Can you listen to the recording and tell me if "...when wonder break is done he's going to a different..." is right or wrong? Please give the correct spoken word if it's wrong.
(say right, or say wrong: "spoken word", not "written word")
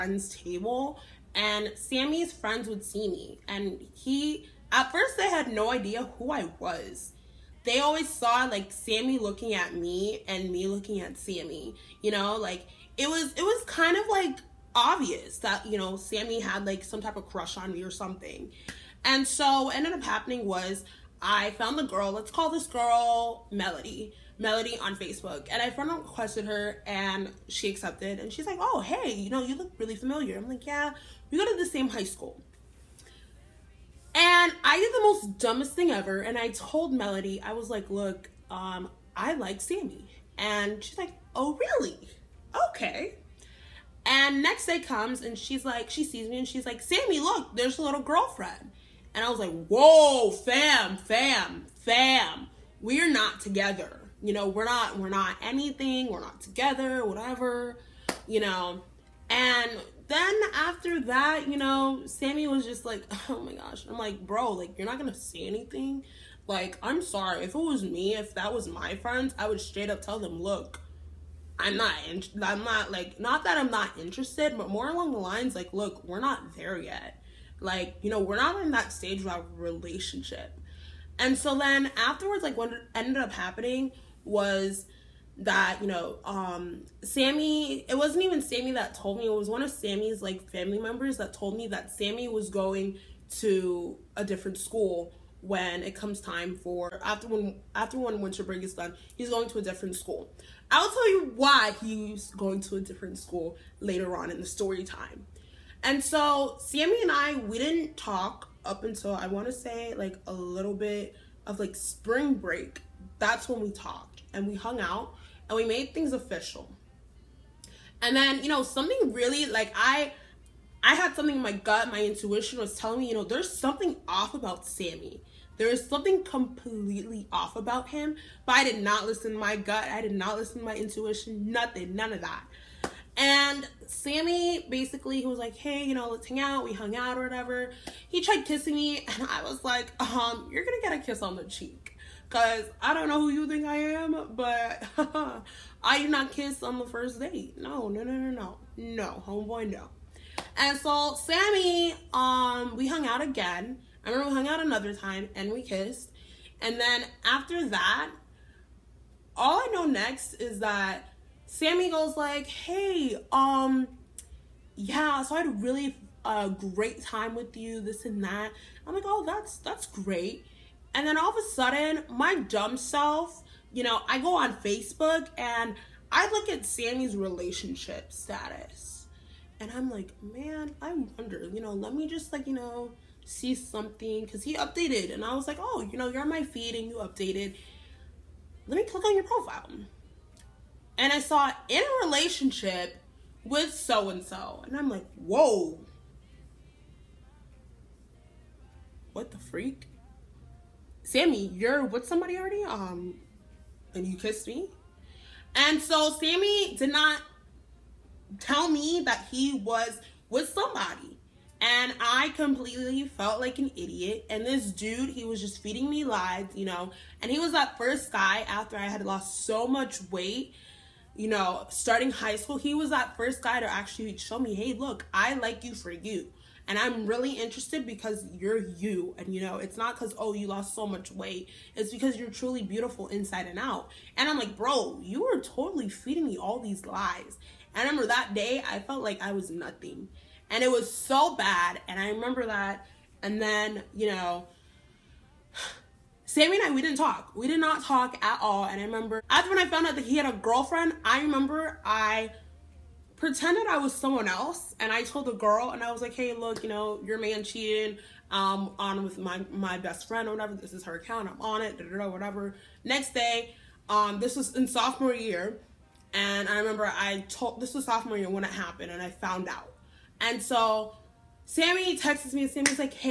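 wrong: "winter", not "wonder".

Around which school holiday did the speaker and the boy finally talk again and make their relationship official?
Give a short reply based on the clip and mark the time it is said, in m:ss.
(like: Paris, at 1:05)
spring break, at 1:51.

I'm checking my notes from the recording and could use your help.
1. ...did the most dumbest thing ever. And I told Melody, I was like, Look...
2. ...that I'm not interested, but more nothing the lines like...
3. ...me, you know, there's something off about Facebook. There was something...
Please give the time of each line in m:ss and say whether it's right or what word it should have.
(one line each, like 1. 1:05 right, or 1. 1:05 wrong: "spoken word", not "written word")
1. 0:34 right
2. 1:13 wrong: "along", not "nothing"
3. 2:03 wrong: "Sammy", not "Facebook".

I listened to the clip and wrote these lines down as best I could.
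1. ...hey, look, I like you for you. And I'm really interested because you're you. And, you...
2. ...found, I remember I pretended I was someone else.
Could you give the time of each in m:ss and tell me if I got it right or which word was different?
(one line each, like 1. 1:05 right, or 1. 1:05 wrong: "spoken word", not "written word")
1. 3:44 right
2. 4:10 wrong: "girlfriend", not "found".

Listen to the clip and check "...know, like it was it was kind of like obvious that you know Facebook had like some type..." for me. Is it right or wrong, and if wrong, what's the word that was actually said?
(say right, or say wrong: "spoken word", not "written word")
wrong: "Sammy", not "Facebook".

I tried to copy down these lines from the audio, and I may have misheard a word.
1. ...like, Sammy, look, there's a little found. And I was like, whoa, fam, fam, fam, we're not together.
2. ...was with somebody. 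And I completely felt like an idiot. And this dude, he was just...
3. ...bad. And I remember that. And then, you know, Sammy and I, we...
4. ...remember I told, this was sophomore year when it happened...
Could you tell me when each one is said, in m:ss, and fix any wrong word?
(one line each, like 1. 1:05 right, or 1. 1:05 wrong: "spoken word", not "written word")
1. 0:46 wrong: "girlfriend", not "found"
2. 3:29 right
3. 4:01 right
4. 4:26 right.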